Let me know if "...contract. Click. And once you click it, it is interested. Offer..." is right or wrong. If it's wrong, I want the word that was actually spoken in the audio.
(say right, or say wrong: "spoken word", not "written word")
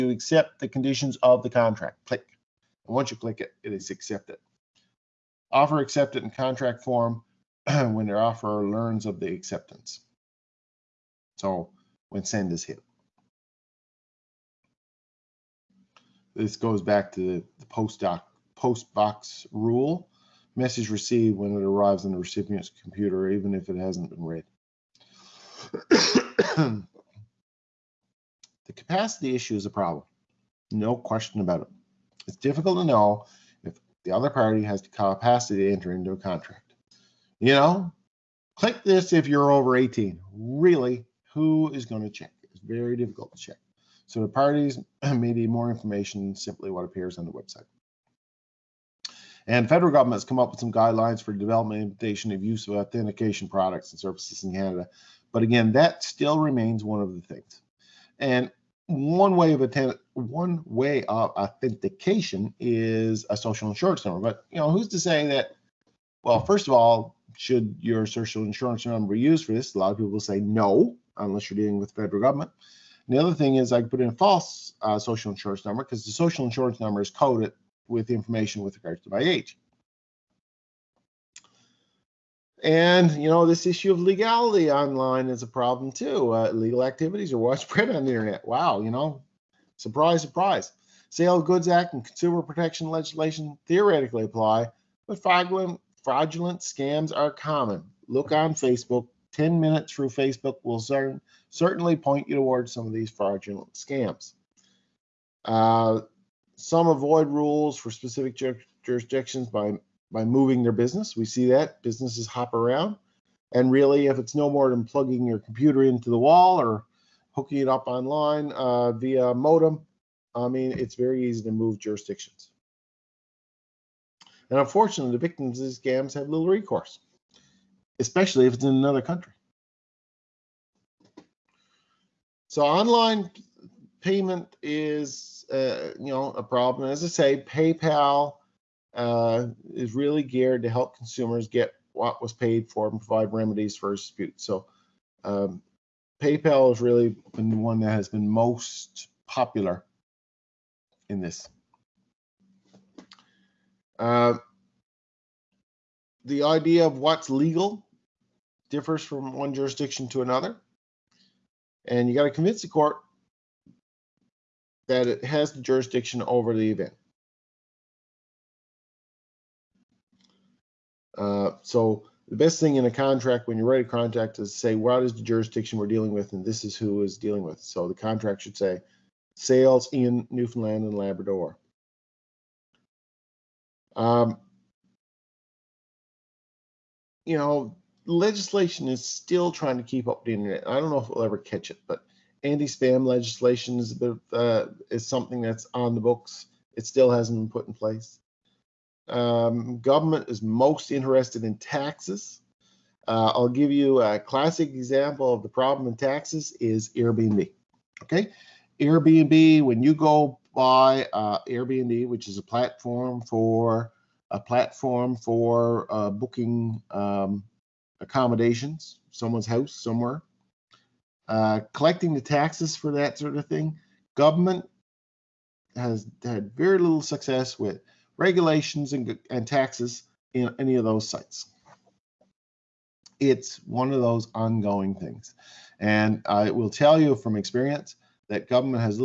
wrong: "accepted", not "interested".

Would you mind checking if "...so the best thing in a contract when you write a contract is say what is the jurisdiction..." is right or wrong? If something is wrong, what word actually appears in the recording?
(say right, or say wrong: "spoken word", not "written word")
right.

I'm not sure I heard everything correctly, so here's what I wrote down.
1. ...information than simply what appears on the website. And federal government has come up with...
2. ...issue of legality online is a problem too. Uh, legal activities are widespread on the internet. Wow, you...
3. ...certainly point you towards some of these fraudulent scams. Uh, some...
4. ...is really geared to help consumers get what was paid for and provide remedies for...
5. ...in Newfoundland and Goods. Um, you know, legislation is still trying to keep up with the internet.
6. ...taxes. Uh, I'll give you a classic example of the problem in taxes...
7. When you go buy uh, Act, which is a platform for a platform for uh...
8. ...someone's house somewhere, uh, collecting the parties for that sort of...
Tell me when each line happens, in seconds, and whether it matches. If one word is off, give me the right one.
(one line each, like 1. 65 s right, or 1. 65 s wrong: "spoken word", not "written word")
1. 45 s right
2. 83 s right
3. 101 s right
4. 139 s right
5. 179 s wrong: "Labrador", not "Goods"
6. 201 s right
7. 209 s wrong: "Airbnb", not "Act"
8. 219 s wrong: "taxes", not "parties".